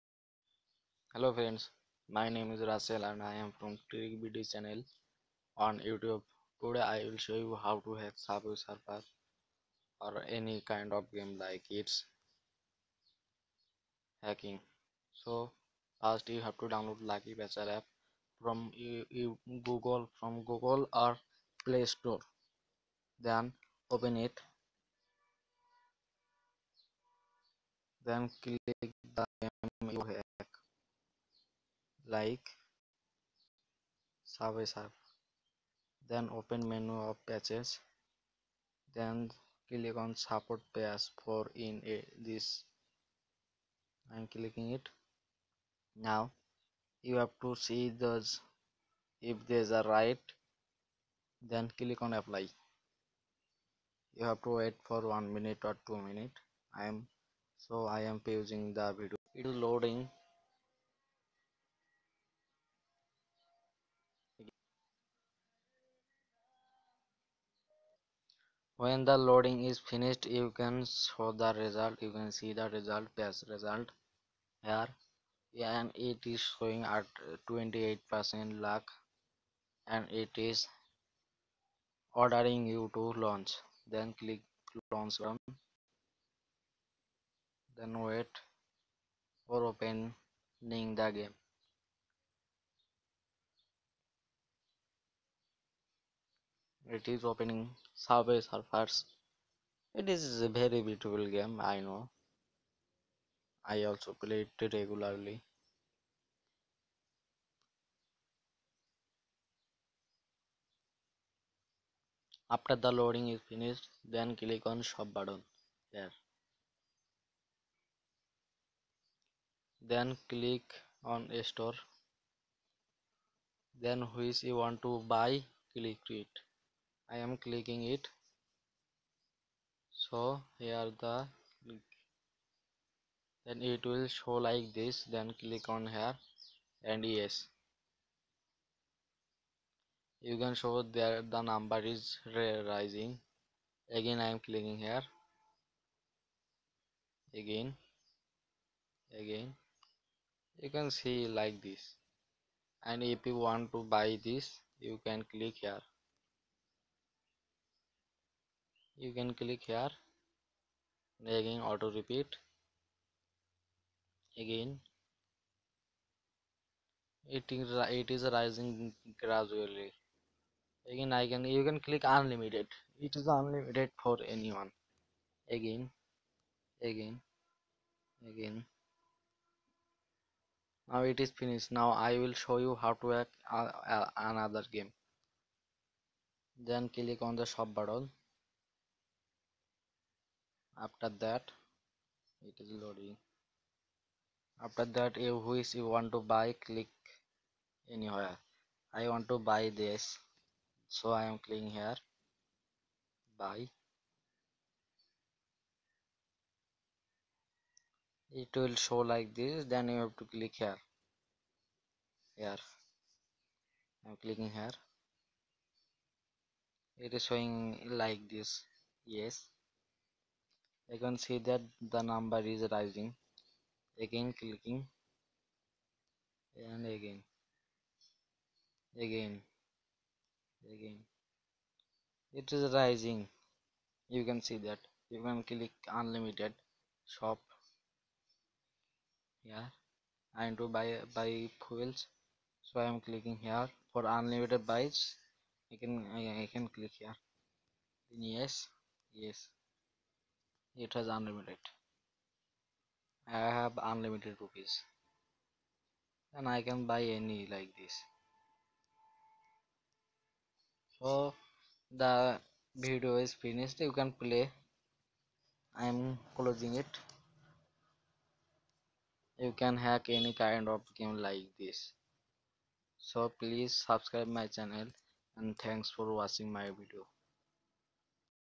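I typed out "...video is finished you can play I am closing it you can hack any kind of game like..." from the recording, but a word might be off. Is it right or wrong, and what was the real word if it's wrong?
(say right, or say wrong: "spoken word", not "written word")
right.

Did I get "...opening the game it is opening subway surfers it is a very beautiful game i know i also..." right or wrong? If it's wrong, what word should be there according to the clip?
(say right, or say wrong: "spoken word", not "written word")
right.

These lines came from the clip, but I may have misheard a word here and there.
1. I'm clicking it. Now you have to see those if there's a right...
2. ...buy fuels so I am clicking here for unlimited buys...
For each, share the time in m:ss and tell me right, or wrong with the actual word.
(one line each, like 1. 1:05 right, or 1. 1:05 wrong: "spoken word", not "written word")
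1. 0:44 right
2. 4:01 right.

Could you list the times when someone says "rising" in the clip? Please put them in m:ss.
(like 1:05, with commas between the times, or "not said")
2:22, 2:48, 3:42, 3:52.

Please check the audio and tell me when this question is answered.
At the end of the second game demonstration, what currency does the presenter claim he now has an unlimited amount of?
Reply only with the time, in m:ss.
4:14.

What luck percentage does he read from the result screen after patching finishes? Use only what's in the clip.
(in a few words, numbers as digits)
28 percent.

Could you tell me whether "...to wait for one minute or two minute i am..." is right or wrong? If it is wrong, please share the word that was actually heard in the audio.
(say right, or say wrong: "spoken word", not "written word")
right.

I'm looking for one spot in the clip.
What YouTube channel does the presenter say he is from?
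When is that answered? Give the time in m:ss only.
0:03.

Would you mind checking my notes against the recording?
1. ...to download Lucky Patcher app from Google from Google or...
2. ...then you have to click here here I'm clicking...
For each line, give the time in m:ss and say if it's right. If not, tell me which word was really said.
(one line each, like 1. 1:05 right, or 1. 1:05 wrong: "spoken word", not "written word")
1. 0:16 right
2. 3:29 right.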